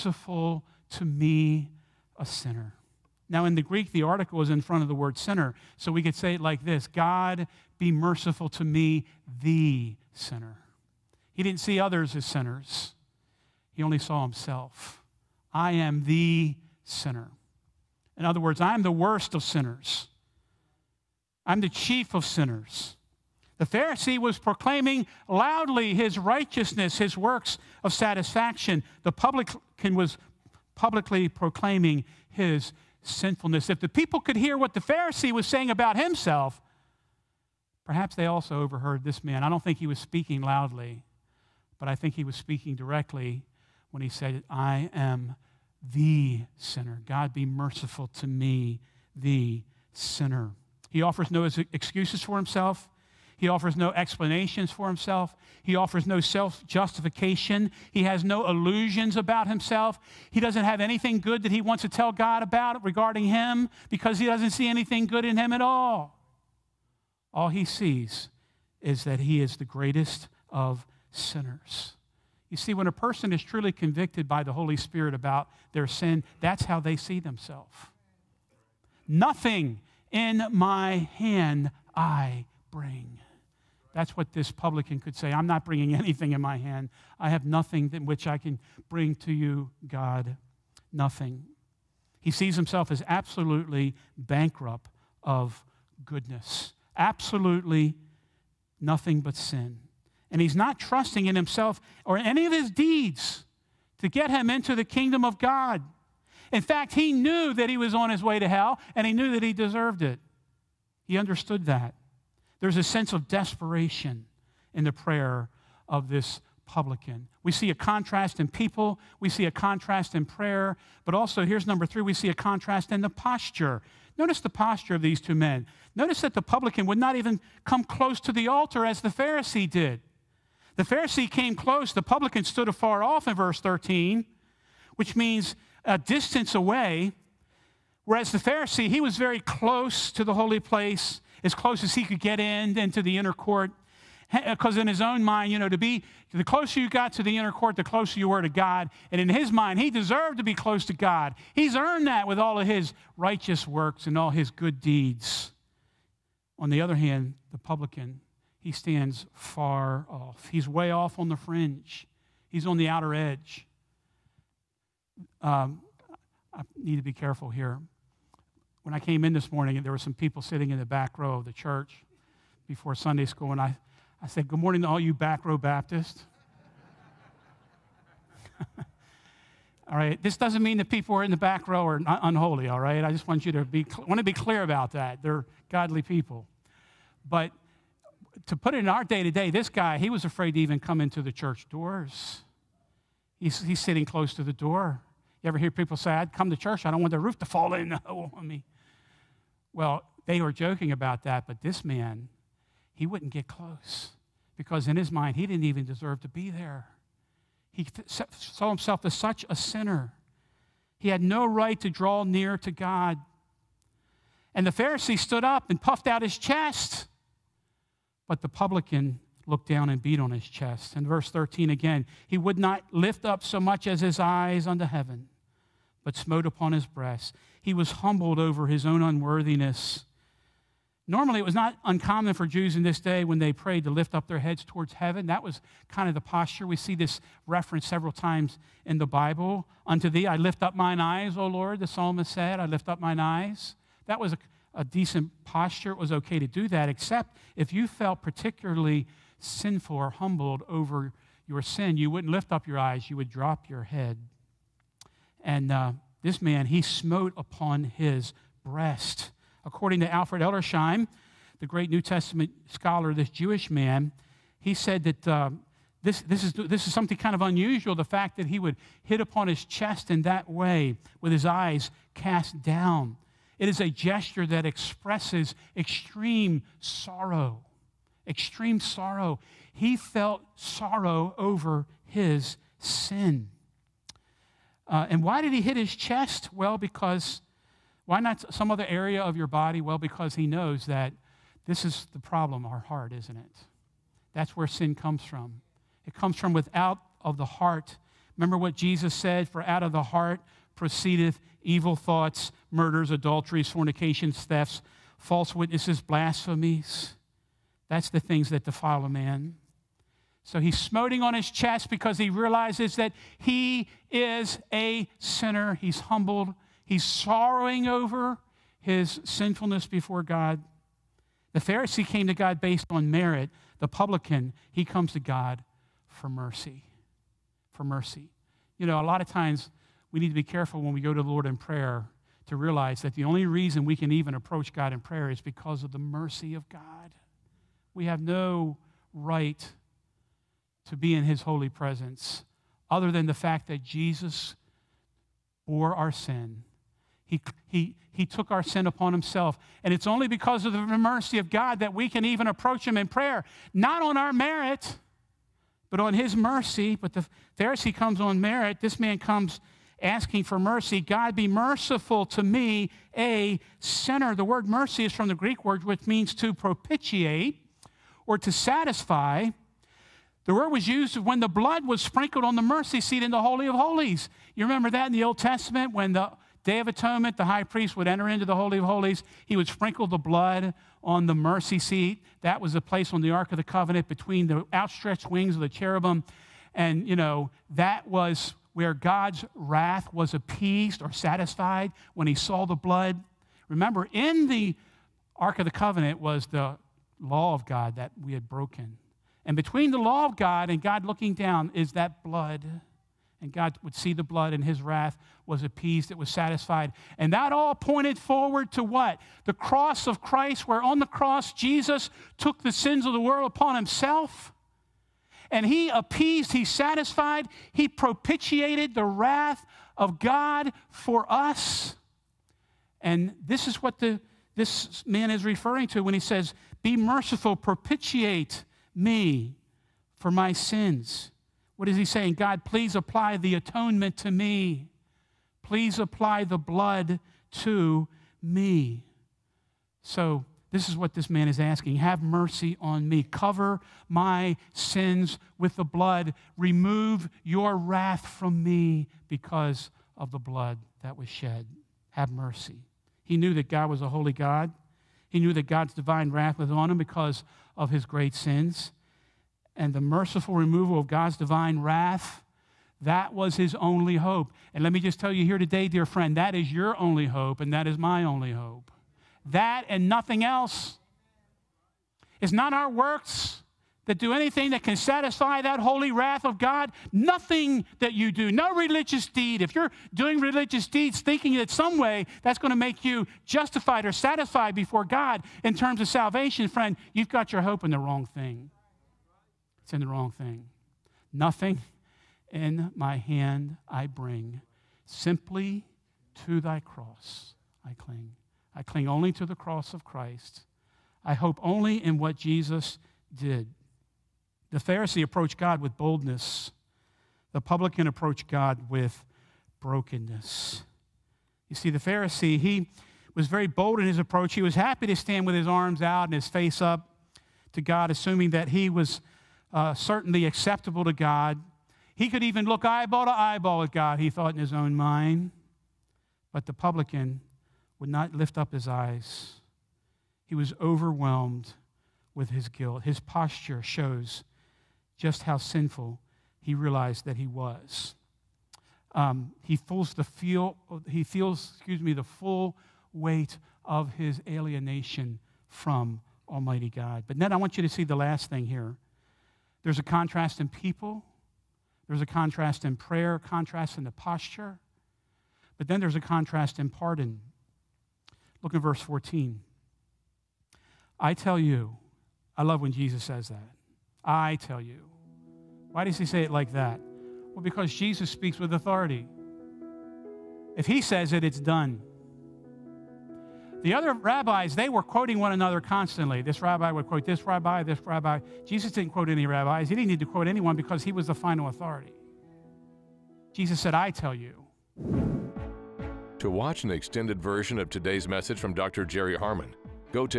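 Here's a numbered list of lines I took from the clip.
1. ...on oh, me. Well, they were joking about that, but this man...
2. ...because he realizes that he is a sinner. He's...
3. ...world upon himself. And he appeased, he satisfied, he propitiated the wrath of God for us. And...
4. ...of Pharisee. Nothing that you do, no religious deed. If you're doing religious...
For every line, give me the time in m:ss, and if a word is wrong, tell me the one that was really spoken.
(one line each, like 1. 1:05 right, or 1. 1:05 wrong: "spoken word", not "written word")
1. 3:17 right
2. 5:11 right
3. 6:53 right
4. 7:56 wrong: "God", not "Pharisee".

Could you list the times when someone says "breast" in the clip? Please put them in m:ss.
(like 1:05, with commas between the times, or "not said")
3:46, 4:18.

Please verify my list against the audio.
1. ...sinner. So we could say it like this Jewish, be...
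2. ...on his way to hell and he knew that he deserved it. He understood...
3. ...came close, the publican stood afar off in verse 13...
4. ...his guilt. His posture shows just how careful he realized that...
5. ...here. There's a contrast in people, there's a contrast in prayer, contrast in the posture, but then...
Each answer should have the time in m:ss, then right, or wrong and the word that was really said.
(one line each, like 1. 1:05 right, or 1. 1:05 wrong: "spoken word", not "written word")
1. 0:05 wrong: "God", not "Jewish"
2. 1:47 right
3. 2:11 right
4. 8:52 wrong: "sinful", not "careful"
5. 9:08 right.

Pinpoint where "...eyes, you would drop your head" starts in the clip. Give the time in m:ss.
4:12.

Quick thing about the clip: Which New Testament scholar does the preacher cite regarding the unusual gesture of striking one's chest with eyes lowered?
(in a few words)
Alfred Edersheim.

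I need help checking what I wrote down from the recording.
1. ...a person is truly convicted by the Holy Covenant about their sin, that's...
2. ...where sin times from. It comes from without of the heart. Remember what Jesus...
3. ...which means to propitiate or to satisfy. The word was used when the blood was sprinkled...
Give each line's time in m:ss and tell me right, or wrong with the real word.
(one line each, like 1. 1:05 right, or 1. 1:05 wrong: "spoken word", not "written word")
1. 1:12 wrong: "Spirit", not "Covenant"
2. 4:54 wrong: "comes", not "times"
3. 6:05 right.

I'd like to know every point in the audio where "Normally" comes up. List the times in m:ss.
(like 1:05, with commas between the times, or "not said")
3:51.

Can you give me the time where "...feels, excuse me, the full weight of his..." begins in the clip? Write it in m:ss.
9:01.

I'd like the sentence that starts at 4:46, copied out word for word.
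Well, because, why not some other area of your body?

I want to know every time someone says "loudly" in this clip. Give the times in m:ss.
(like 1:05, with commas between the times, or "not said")
0:25, 0:40.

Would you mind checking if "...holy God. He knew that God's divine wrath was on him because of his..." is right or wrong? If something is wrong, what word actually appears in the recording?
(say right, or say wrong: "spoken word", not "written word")
right.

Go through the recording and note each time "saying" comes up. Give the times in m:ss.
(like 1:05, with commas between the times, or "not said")
0:35, 7:12.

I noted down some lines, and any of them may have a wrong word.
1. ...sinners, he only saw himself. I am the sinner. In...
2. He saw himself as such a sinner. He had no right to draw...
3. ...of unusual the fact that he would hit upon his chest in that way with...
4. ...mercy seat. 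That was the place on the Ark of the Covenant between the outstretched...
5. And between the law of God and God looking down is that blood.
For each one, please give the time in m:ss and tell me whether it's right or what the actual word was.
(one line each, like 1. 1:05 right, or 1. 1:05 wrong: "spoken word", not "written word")
1. 0:12 right
2. 3:27 right
3. 4:27 right
4. 6:21 right
5. 6:39 right.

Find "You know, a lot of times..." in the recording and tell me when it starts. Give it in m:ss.
5:28.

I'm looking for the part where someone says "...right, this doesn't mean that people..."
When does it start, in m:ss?
2:59.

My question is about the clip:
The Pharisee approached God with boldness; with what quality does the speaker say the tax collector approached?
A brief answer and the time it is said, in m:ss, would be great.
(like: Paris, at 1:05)
brokenness, at 8:29.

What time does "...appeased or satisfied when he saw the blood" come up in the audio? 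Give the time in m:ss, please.
6:30.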